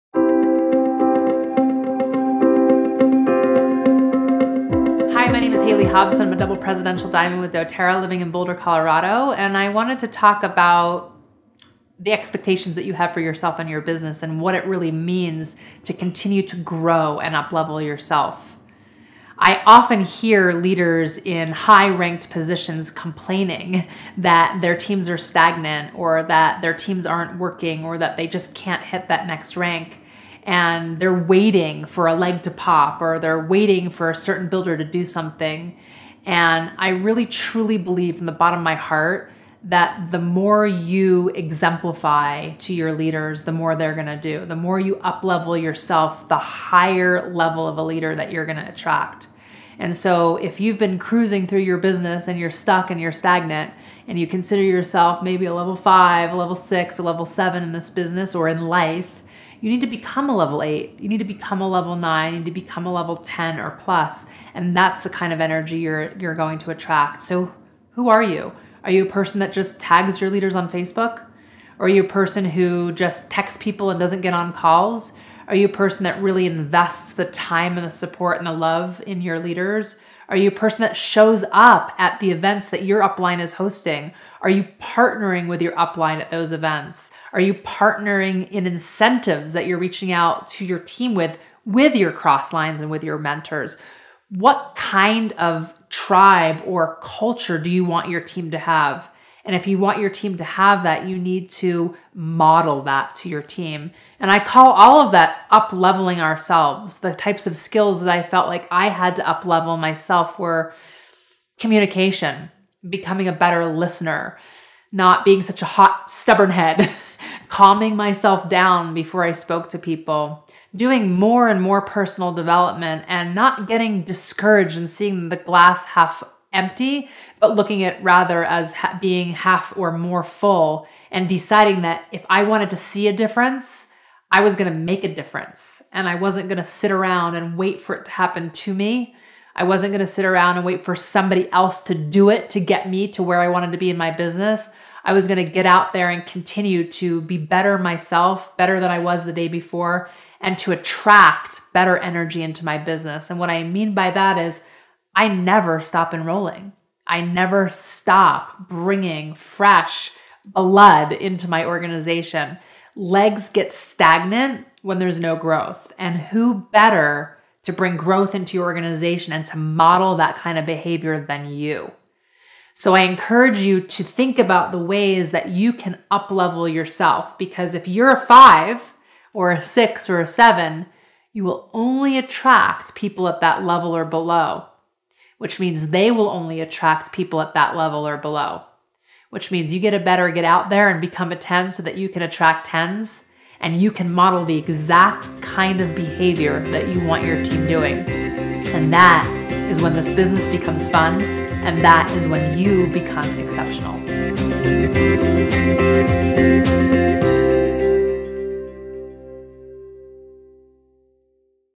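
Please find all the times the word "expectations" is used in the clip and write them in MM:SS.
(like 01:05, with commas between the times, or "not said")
00:12.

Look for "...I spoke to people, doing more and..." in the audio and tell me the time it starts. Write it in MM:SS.
01:59.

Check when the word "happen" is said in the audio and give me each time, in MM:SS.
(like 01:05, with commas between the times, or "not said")
02:18.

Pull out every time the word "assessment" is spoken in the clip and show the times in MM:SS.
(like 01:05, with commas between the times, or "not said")
not said.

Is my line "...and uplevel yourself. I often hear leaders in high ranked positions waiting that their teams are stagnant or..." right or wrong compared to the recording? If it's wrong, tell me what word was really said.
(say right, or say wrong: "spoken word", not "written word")
wrong: "complaining", not "waiting".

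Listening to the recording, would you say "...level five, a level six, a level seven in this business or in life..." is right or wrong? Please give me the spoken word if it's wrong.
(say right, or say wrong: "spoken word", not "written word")
right.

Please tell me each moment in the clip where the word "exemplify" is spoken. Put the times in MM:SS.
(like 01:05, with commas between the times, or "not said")
00:41.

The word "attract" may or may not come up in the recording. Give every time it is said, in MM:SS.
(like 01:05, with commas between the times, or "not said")
00:48, 01:06, 02:30, 03:02, 03:06, 03:12.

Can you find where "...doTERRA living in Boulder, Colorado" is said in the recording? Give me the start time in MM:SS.
00:07.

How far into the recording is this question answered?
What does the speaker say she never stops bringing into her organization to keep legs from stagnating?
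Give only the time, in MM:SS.
02:39.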